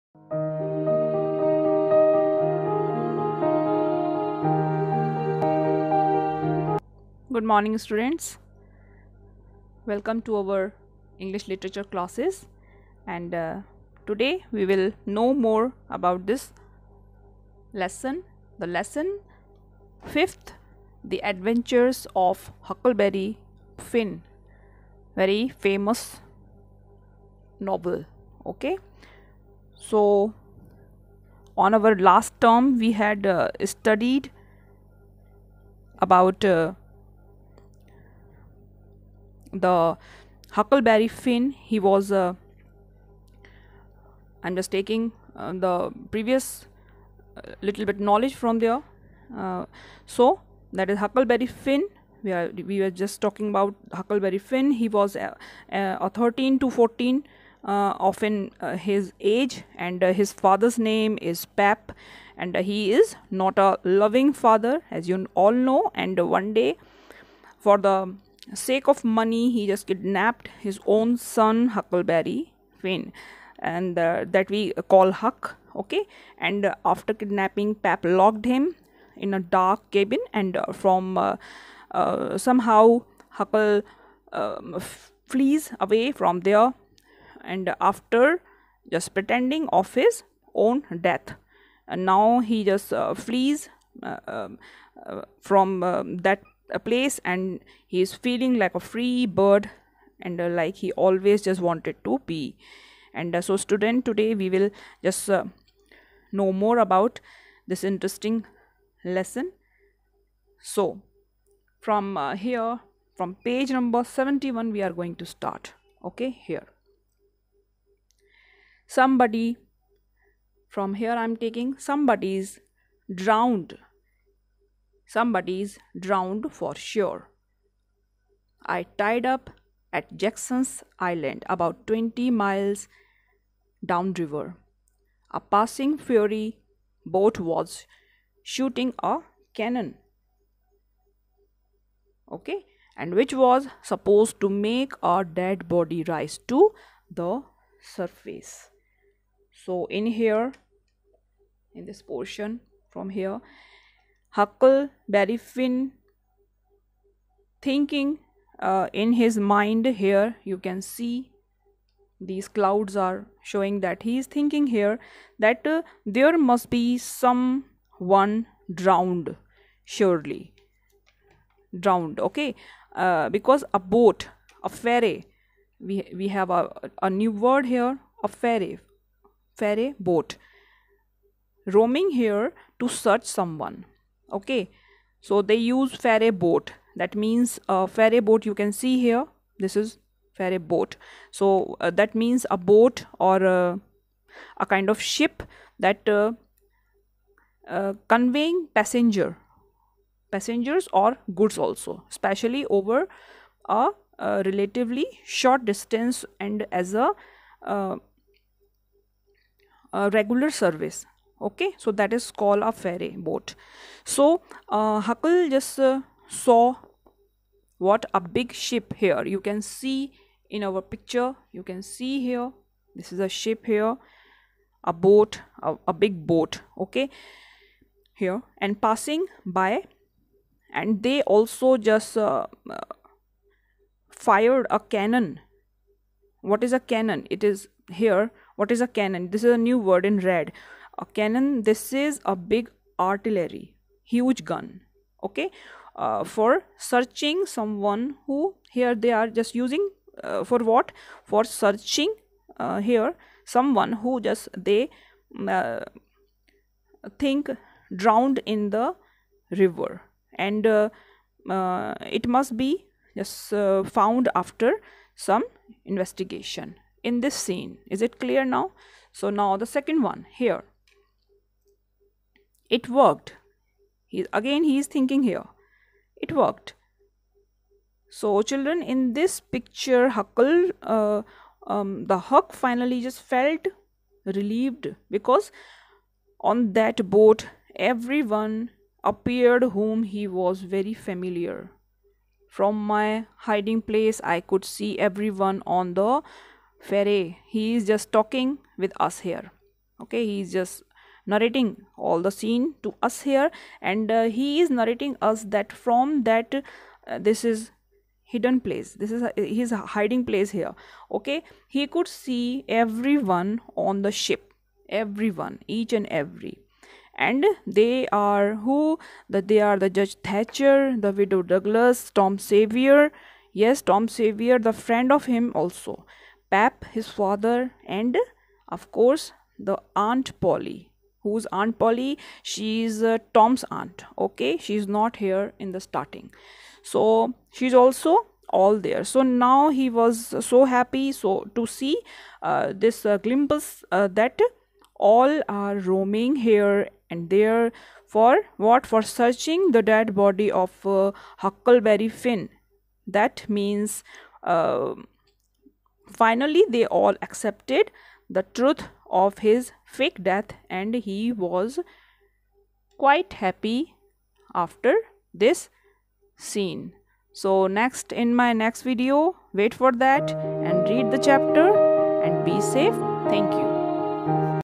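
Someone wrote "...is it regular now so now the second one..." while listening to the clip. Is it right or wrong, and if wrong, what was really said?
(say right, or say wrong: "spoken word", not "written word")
wrong: "clear", not "regular".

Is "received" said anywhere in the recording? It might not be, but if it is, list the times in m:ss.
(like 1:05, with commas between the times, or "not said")
not said.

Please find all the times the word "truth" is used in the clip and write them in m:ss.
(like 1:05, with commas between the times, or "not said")
5:58.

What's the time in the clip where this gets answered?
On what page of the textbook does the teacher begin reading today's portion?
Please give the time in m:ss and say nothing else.
1:53.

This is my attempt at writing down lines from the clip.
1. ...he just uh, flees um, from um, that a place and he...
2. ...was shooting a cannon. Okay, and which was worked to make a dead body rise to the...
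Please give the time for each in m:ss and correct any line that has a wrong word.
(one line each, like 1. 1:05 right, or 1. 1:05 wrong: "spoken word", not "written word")
1. 1:32 right
2. 2:17 wrong: "supposed", not "worked".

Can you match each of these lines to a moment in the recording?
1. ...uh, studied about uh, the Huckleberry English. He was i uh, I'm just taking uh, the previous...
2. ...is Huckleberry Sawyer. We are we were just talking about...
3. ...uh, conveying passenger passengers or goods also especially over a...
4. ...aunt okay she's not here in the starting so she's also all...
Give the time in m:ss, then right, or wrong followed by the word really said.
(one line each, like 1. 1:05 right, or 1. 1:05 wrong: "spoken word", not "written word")
1. 0:33 wrong: "Finn", not "English"
2. 0:50 wrong: "Finn", not "Sawyer"
3. 3:17 right
4. 5:33 right.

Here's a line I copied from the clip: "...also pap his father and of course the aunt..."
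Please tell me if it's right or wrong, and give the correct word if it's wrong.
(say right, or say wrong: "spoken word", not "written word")
right.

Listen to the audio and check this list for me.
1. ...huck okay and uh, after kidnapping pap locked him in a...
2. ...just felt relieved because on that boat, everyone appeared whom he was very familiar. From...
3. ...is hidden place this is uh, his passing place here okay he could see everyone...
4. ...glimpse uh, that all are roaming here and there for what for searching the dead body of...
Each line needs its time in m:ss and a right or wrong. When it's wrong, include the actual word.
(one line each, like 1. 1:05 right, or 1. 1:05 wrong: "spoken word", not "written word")
1. 1:15 right
2. 4:43 right
3. 5:07 wrong: "hiding", not "passing"
4. 5:43 right.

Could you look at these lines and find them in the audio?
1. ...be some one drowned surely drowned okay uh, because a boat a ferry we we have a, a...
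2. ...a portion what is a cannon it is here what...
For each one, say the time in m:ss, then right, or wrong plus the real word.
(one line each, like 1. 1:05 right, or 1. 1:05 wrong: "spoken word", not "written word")
1. 2:46 right
2. 3:54 wrong: "cannon", not "portion".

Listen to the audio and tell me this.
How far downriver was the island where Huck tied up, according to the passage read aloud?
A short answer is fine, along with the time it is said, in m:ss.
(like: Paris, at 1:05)
About 20 miles, at 2:11.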